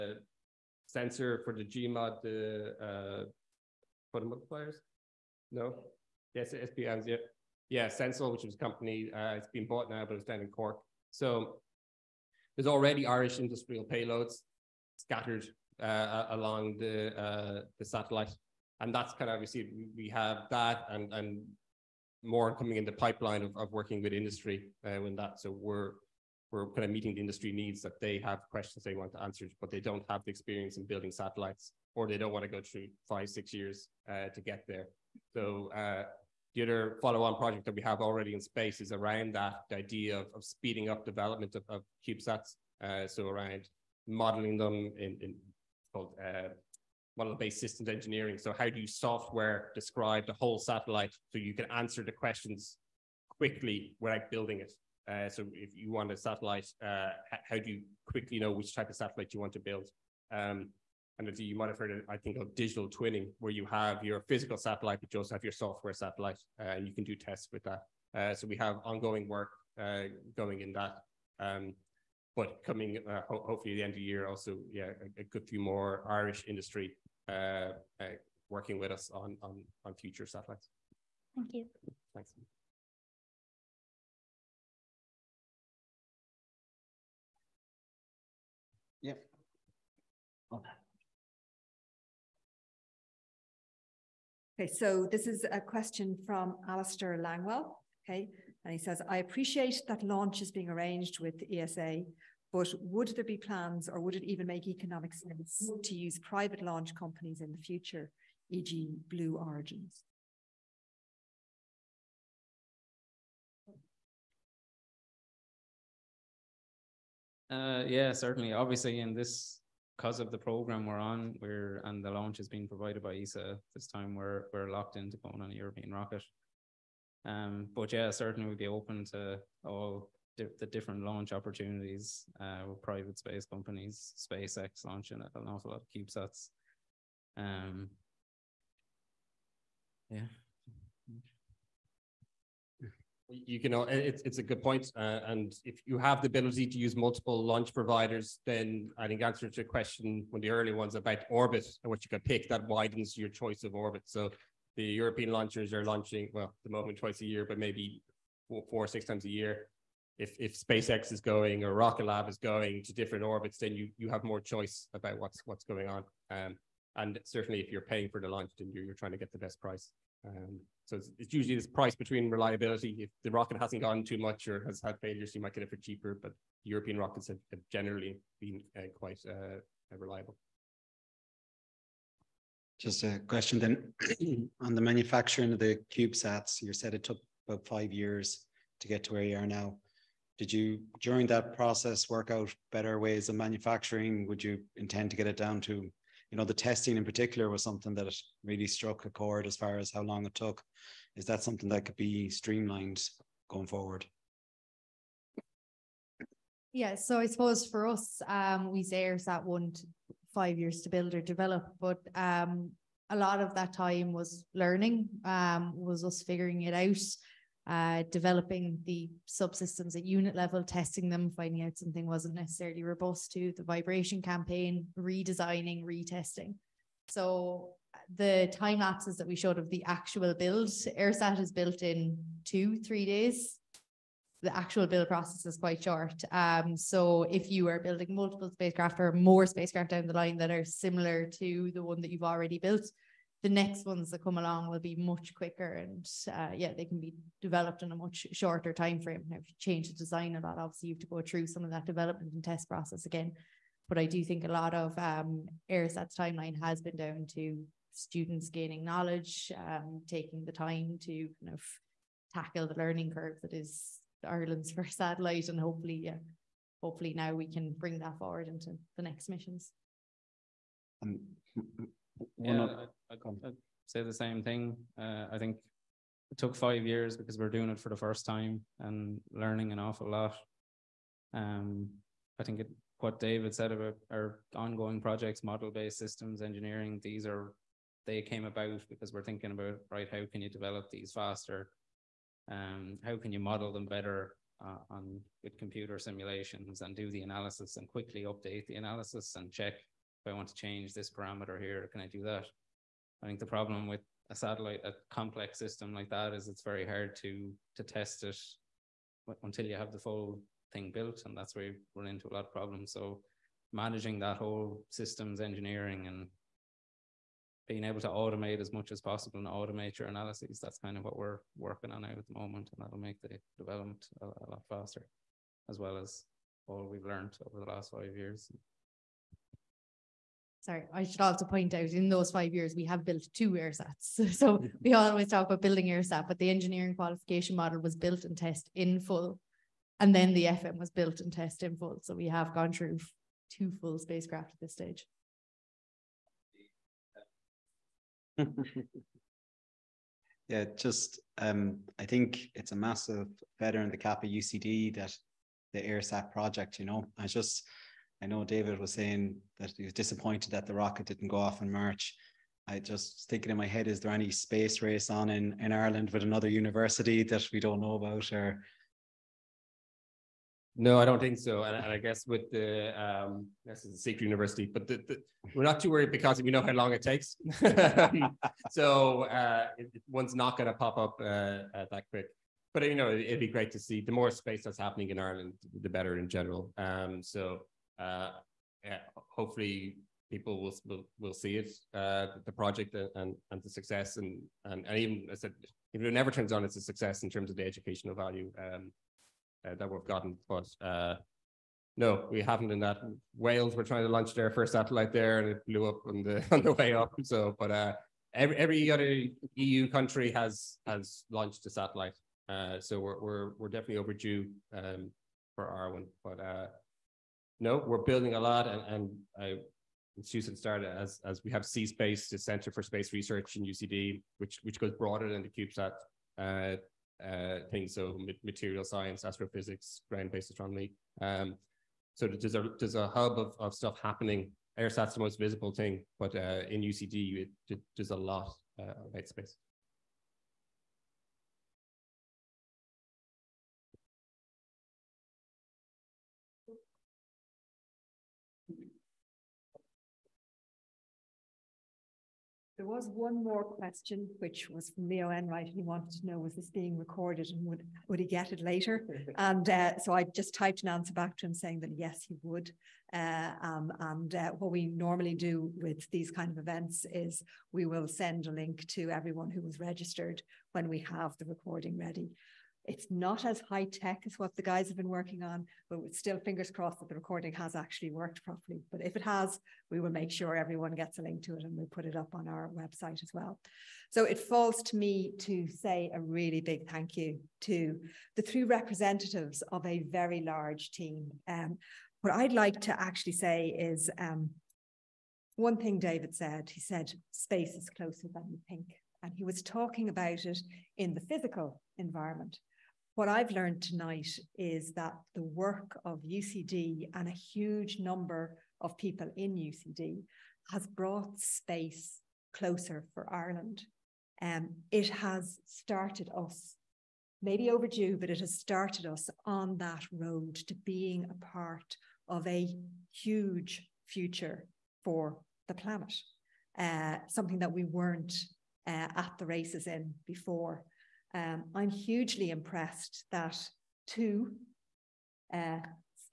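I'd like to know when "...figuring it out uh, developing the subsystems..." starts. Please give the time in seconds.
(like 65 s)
216 s.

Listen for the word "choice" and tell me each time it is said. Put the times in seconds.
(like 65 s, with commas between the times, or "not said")
153 s, 164 s.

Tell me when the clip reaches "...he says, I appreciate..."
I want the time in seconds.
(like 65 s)
98 s.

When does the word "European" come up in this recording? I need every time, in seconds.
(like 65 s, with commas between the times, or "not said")
125 s, 154 s, 176 s.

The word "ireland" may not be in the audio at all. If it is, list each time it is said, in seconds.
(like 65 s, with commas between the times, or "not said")
264 s, 365 s, 385 s, 513 s.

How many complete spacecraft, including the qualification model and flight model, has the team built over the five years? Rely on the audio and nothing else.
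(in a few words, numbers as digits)
2.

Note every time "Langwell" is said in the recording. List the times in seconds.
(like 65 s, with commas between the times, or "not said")
97 s.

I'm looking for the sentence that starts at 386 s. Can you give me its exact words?
Um, so uh, hopefully people will, will, will see it, uh, the project and, and the success.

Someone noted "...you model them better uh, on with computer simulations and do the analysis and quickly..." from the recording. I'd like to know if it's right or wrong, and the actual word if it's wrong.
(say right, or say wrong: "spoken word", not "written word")
right.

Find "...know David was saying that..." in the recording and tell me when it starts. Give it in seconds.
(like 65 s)
358 s.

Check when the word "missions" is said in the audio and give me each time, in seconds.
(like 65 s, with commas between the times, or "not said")
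269 s.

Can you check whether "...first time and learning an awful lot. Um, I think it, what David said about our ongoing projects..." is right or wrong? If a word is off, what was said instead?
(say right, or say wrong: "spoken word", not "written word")
right.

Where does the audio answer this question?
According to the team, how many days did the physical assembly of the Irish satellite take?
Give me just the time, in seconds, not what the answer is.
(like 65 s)
232 s.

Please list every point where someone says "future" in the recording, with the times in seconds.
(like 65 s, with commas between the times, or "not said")
79 s, 107 s, 524 s.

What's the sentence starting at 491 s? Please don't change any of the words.
Um, what I'd like to actually say is um, one thing David said.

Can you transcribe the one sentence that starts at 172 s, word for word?
If the rocket hasn't gone too much or has had failures, you might get it for cheaper.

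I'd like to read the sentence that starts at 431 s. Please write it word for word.
Um, so there's a, there's a hub of, of stuff happening.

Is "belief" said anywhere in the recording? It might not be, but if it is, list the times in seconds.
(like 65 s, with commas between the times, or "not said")
not said.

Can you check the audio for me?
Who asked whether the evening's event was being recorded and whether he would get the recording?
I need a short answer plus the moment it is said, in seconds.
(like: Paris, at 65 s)
Leo Enright, at 455 s.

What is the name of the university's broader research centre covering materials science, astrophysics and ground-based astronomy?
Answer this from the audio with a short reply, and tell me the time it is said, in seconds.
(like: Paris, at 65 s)
C-Space, at 421 s.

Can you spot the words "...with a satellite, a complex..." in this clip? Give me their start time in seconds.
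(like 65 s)
303 s.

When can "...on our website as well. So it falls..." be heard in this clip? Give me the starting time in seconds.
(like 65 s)
482 s.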